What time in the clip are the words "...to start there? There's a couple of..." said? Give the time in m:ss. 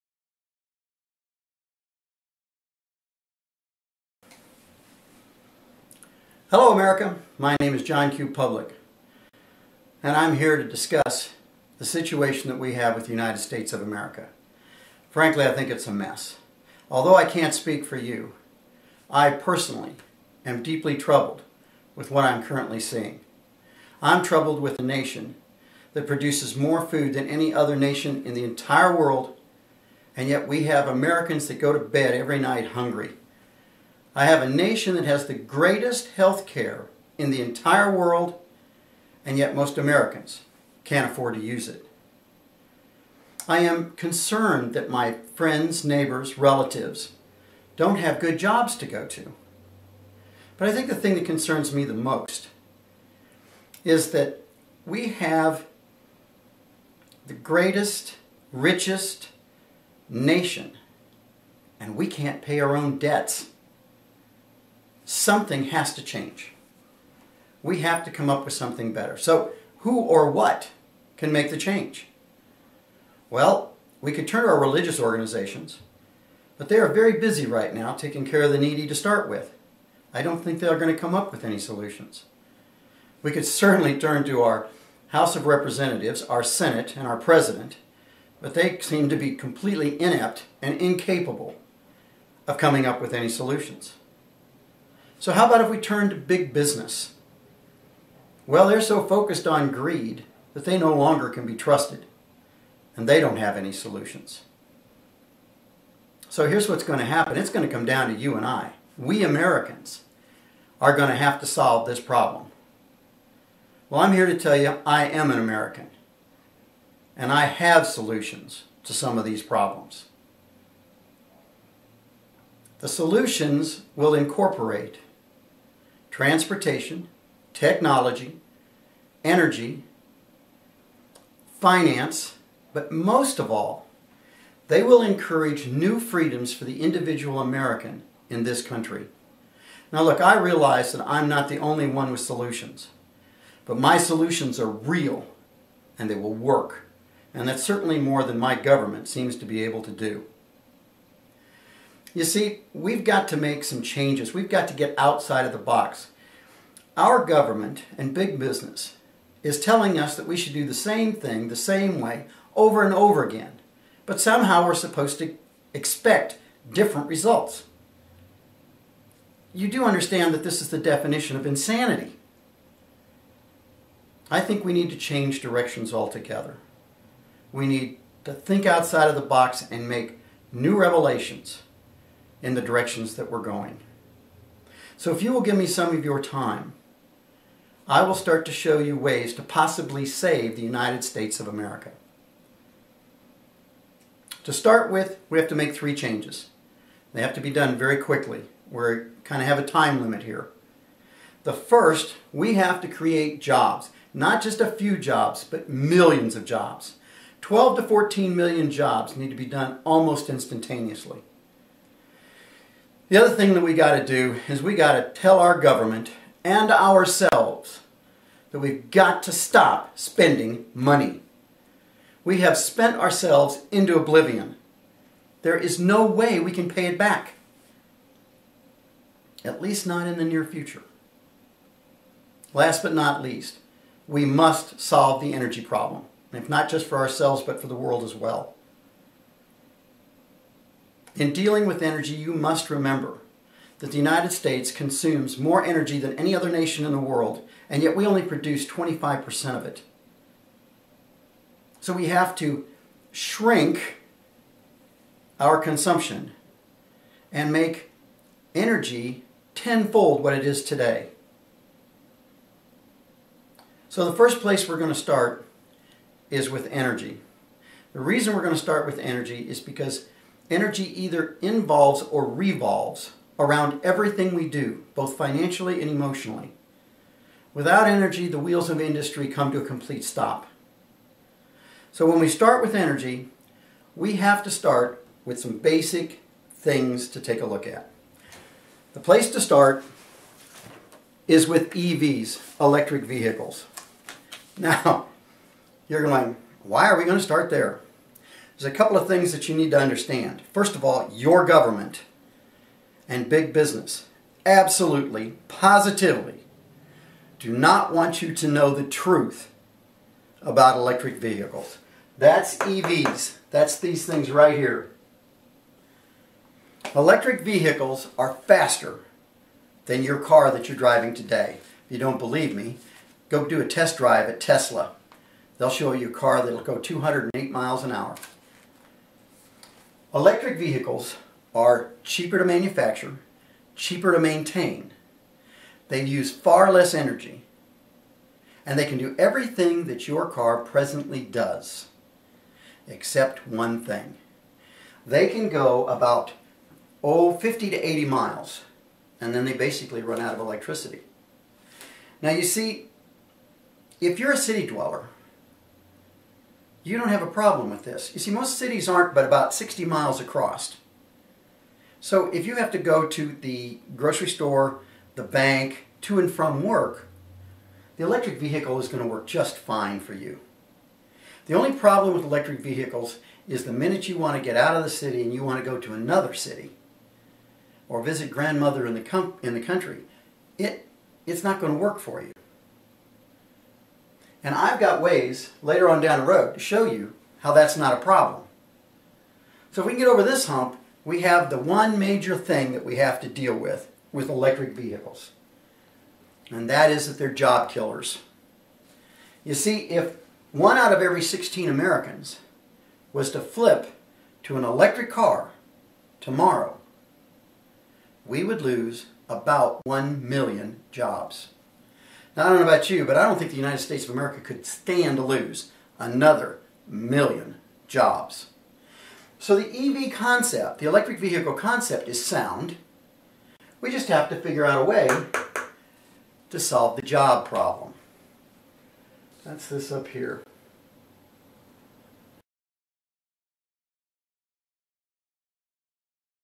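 4:57.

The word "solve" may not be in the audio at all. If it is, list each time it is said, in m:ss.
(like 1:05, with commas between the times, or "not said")
1:51, 3:54, 7:06.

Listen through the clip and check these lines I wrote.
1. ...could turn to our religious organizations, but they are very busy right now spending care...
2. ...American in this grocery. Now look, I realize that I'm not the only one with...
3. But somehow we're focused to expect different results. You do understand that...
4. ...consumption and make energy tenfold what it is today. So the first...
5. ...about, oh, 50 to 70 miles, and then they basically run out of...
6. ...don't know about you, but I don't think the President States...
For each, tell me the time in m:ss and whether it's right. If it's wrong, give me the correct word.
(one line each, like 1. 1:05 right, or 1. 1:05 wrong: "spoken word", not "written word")
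1. 1:14 wrong: "taking", not "spending"
2. 2:17 wrong: "country", not "grocery"
3. 2:44 wrong: "supposed", not "focused"
4. 4:15 right
5. 5:45 wrong: "80", not "70"
6. 6:52 wrong: "United", not "President".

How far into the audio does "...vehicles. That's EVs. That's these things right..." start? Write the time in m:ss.
5:11.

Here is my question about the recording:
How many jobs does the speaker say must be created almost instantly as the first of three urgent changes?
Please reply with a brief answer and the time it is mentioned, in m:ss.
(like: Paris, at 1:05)
12 to 14 million, at 3:27.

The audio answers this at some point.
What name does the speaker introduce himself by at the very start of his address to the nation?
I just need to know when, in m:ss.
0:07.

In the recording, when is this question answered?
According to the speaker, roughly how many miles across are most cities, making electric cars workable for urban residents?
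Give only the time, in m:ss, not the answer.
5:59.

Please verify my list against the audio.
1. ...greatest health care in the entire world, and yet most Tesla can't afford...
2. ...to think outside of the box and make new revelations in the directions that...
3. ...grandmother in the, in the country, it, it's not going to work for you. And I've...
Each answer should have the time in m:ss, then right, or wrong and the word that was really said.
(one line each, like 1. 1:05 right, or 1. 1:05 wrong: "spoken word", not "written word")
1. 0:35 wrong: "Americans", not "Tesla"
2. 2:58 right
3. 6:18 right.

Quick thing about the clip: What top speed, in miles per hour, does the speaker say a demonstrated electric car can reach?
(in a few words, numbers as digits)
208.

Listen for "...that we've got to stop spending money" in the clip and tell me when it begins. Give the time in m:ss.
3:38.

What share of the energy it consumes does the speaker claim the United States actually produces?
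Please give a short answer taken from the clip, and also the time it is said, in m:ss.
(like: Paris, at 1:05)
25%, at 4:08.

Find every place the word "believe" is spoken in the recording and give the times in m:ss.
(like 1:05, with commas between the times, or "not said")
5:22.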